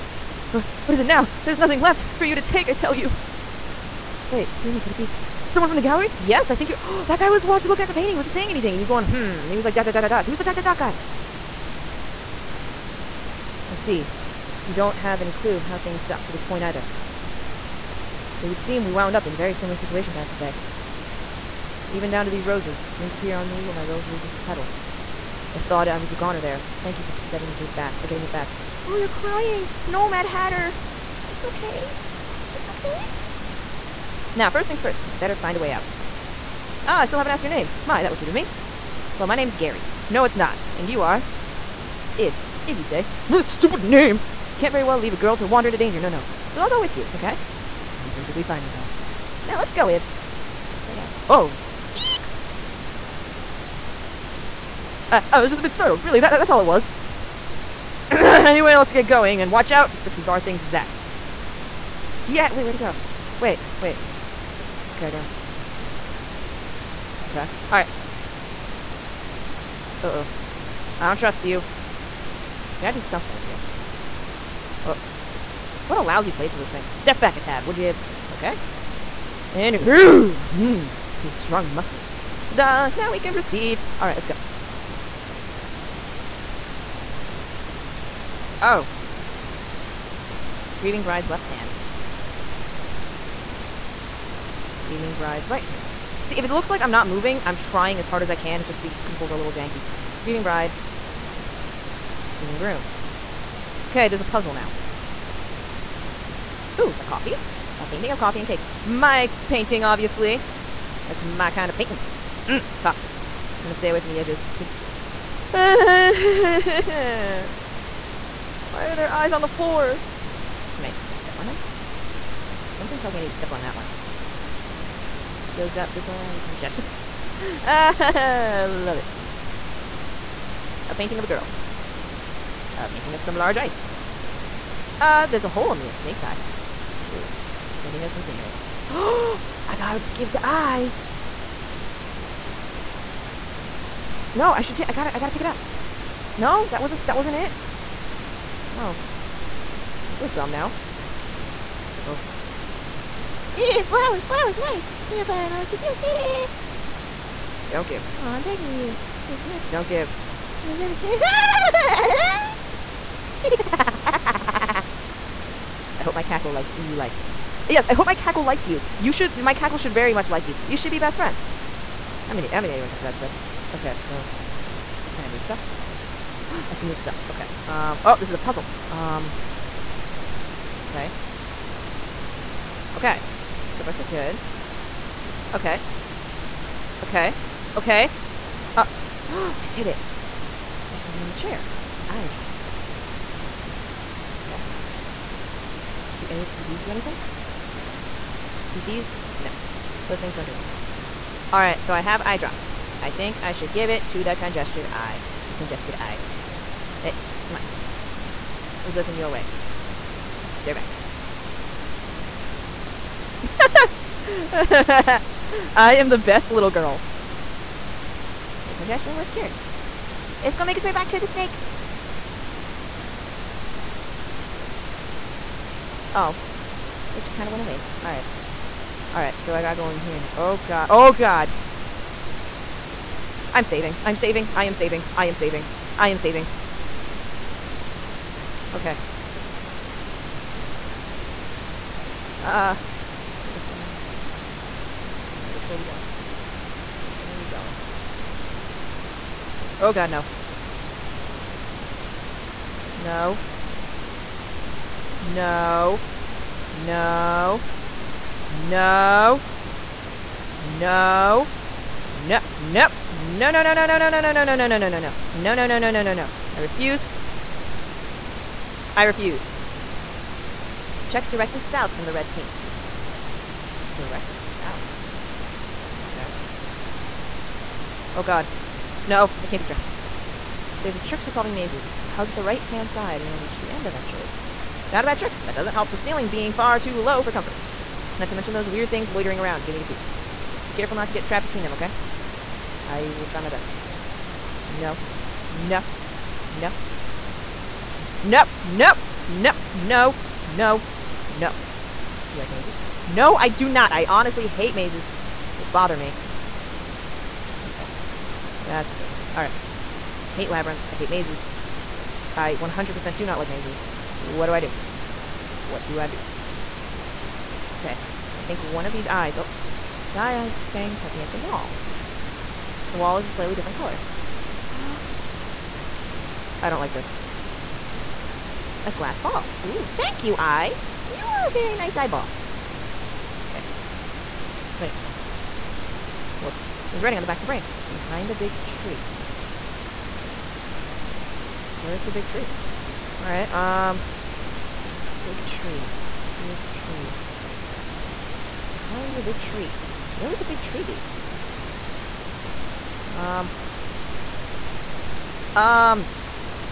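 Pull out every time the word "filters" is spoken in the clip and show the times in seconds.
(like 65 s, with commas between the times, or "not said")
not said.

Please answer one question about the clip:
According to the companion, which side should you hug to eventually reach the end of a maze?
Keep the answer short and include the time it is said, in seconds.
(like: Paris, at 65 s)
right-hand side, at 282 s.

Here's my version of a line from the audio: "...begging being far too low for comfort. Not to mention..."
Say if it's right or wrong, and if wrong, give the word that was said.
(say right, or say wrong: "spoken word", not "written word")
wrong: "ceiling", not "begging".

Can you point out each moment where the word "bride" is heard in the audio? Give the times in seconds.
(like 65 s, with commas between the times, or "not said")
91 s, 95 s, 100 s.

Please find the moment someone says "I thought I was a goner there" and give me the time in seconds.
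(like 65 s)
25 s.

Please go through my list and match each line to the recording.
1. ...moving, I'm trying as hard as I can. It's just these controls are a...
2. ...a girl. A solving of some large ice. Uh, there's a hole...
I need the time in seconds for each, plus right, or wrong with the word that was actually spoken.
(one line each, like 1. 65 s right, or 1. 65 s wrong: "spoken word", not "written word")
1. 97 s right
2. 131 s wrong: "painting", not "solving".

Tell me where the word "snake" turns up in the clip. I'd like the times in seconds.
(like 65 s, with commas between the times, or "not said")
135 s, 221 s.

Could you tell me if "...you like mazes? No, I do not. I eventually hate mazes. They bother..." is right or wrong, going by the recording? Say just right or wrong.
wrong.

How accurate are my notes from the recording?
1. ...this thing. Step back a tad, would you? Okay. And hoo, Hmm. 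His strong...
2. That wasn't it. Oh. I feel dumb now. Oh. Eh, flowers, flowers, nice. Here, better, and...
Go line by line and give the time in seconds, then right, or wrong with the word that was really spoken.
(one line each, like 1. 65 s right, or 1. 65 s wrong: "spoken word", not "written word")
1. 76 s right
2. 147 s wrong: "flower", not "better".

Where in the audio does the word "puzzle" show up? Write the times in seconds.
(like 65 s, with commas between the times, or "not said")
104 s, 178 s.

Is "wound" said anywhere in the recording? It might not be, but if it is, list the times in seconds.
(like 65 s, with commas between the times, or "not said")
18 s, 22 s.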